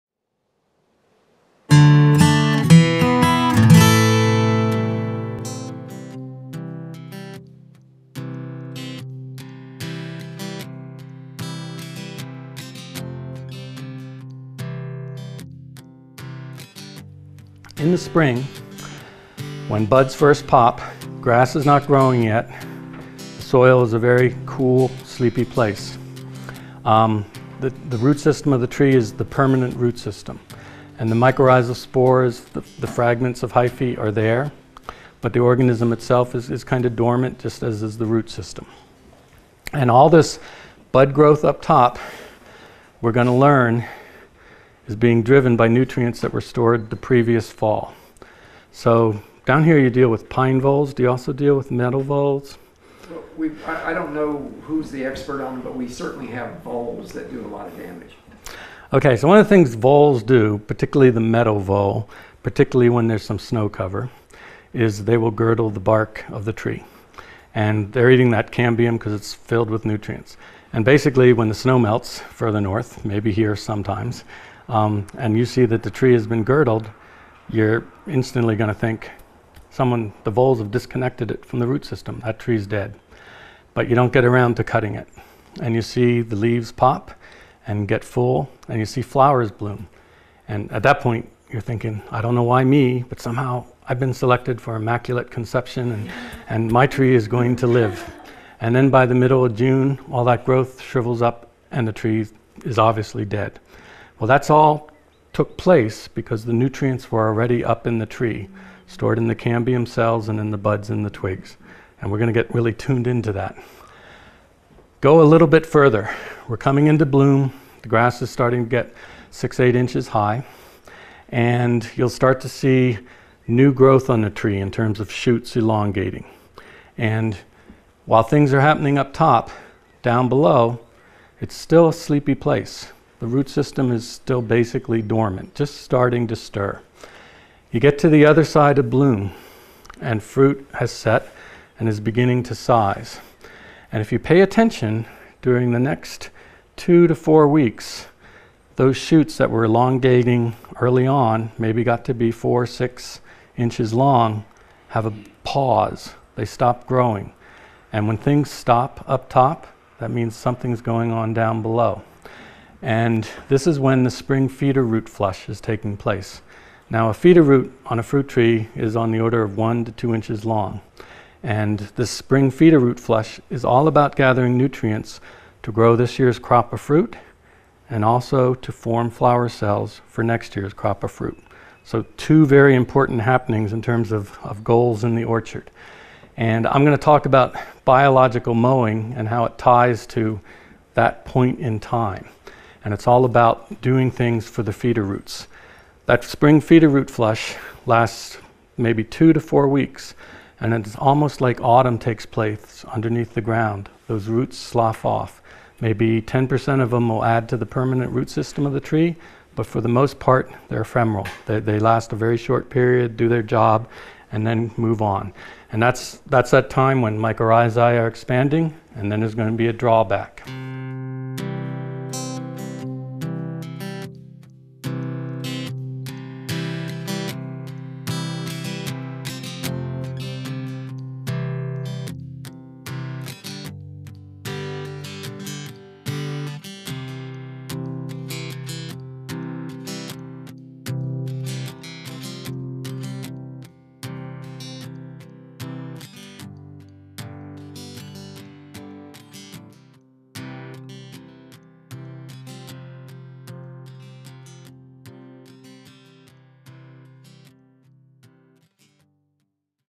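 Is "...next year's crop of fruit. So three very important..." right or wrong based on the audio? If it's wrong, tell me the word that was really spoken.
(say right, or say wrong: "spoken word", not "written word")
wrong: "two", not "three".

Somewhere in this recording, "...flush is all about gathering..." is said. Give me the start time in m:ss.
2:52.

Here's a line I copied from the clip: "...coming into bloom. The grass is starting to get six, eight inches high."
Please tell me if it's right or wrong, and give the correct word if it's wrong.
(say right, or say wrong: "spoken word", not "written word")
right.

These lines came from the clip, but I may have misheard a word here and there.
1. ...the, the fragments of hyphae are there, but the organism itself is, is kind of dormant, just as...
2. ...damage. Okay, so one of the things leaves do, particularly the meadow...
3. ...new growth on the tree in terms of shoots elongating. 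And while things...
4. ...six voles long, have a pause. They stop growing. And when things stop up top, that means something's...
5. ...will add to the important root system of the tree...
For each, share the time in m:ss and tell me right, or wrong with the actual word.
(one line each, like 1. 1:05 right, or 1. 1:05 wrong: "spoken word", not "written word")
1. 0:32 right
2. 0:57 wrong: "voles", not "leaves"
3. 2:03 right
4. 2:32 wrong: "inches", not "voles"
5. 3:27 wrong: "permanent", not "important".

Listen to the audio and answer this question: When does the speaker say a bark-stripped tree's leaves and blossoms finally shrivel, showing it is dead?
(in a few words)
middle of June.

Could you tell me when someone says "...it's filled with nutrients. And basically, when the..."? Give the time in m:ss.
1:09.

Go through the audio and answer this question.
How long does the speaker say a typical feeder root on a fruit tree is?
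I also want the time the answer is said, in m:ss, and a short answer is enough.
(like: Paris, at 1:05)
1 to 2 inches, at 2:49.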